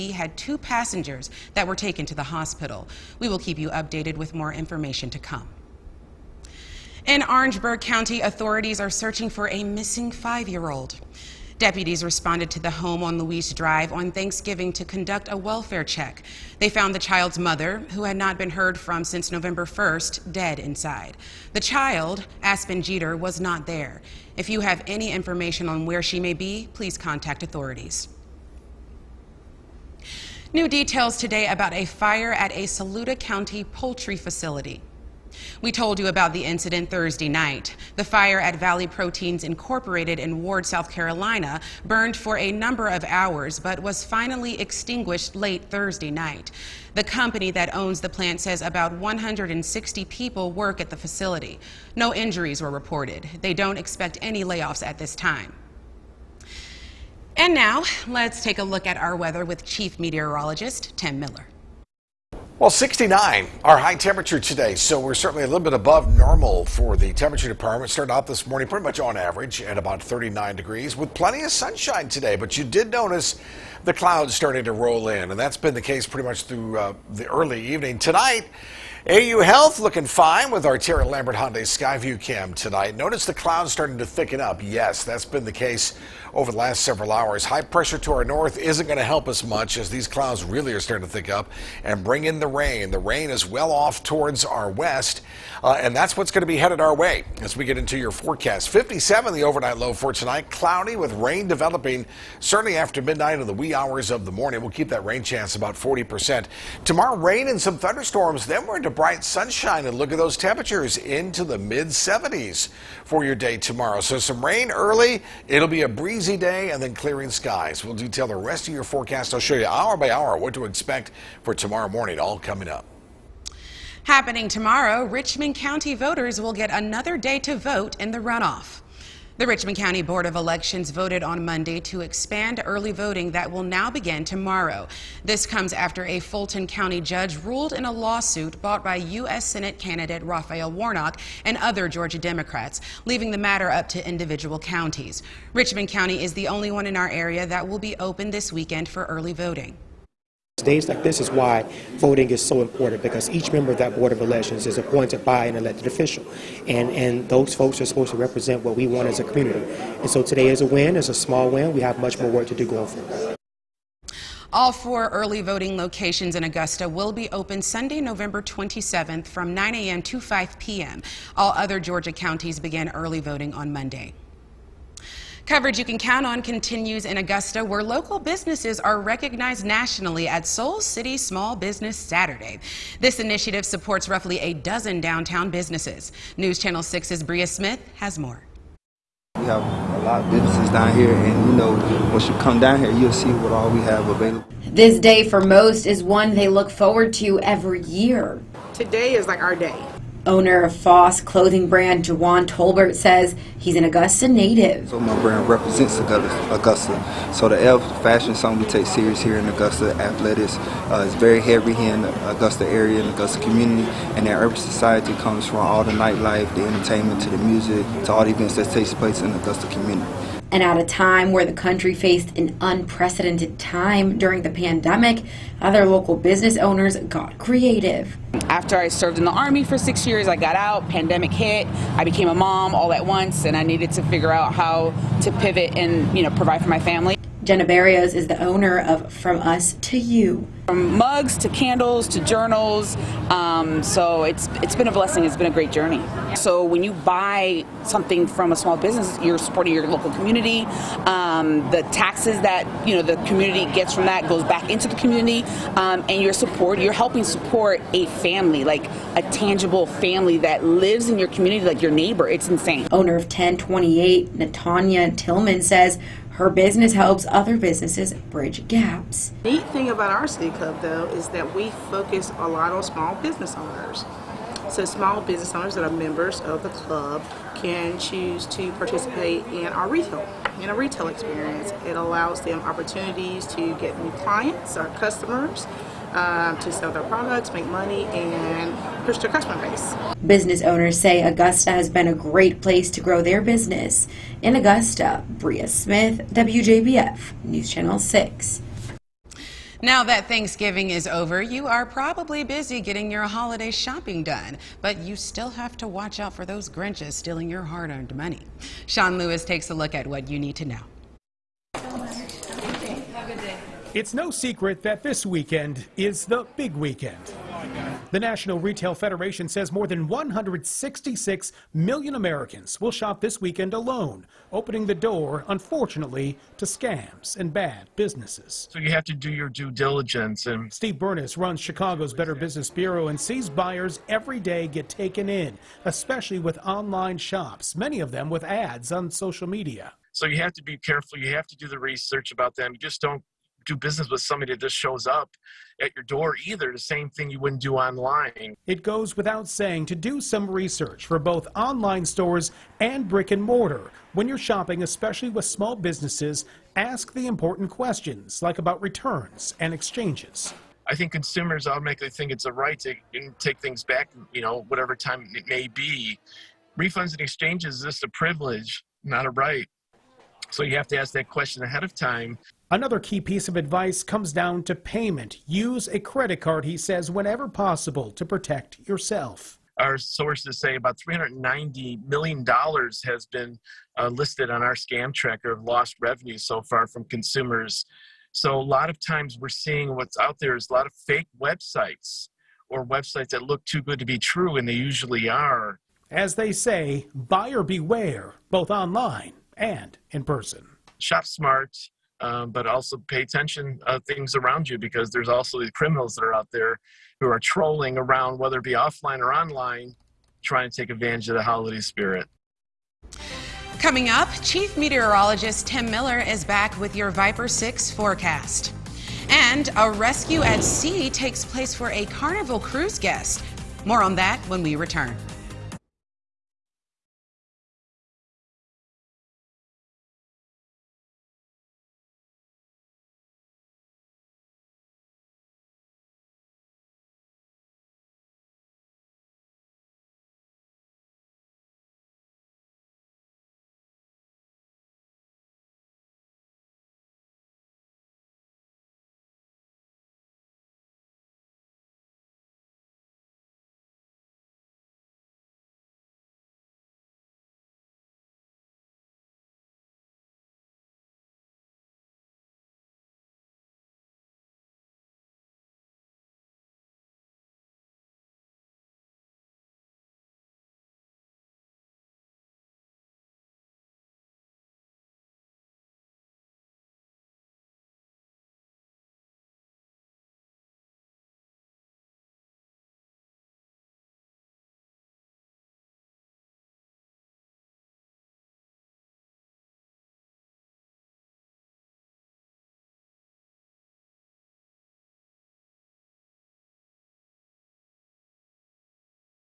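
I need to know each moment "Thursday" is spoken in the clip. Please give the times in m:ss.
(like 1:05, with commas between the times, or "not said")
0:36, 0:45.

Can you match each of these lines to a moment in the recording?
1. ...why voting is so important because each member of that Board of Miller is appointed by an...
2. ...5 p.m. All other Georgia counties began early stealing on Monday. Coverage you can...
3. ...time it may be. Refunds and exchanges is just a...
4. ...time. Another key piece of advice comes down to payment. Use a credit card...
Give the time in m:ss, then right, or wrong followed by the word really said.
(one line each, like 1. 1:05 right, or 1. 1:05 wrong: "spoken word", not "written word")
1. 2:31 wrong: "Elections", not "Miller"
2. 2:50 wrong: "voting", not "stealing"
3. 6:04 right
4. 6:11 right.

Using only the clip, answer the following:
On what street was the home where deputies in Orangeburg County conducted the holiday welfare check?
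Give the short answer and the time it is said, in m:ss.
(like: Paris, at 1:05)
Louise Drive, at 0:13.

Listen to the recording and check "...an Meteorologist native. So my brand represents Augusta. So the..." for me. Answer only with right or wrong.
wrong.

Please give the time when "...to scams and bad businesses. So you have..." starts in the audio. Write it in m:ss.
5:26.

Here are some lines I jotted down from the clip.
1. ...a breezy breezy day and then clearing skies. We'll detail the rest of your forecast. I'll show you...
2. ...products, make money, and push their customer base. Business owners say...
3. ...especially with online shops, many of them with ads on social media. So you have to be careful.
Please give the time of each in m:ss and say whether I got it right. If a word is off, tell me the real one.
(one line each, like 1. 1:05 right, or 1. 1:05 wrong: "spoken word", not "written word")
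1. 1:55 right
2. 4:47 right
3. 5:35 right.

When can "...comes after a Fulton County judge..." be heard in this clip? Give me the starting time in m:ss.
2:15.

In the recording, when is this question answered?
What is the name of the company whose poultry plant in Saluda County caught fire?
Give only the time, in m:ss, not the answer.
0:38.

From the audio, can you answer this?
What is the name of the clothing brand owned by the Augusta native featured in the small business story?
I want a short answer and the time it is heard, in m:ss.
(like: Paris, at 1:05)
Foss, at 3:20.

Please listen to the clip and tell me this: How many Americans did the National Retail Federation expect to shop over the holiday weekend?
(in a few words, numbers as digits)
166 million.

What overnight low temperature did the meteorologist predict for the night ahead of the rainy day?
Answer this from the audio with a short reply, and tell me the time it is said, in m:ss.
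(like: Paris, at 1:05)
57, at 1:38.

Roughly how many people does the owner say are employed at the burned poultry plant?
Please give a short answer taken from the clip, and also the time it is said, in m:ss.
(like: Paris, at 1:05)
160, at 0:48.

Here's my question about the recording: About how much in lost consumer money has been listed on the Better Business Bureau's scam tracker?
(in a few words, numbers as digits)
$390 million.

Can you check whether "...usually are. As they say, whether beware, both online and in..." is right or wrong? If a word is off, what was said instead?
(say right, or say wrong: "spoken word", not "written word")
wrong: "buyer", not "whether".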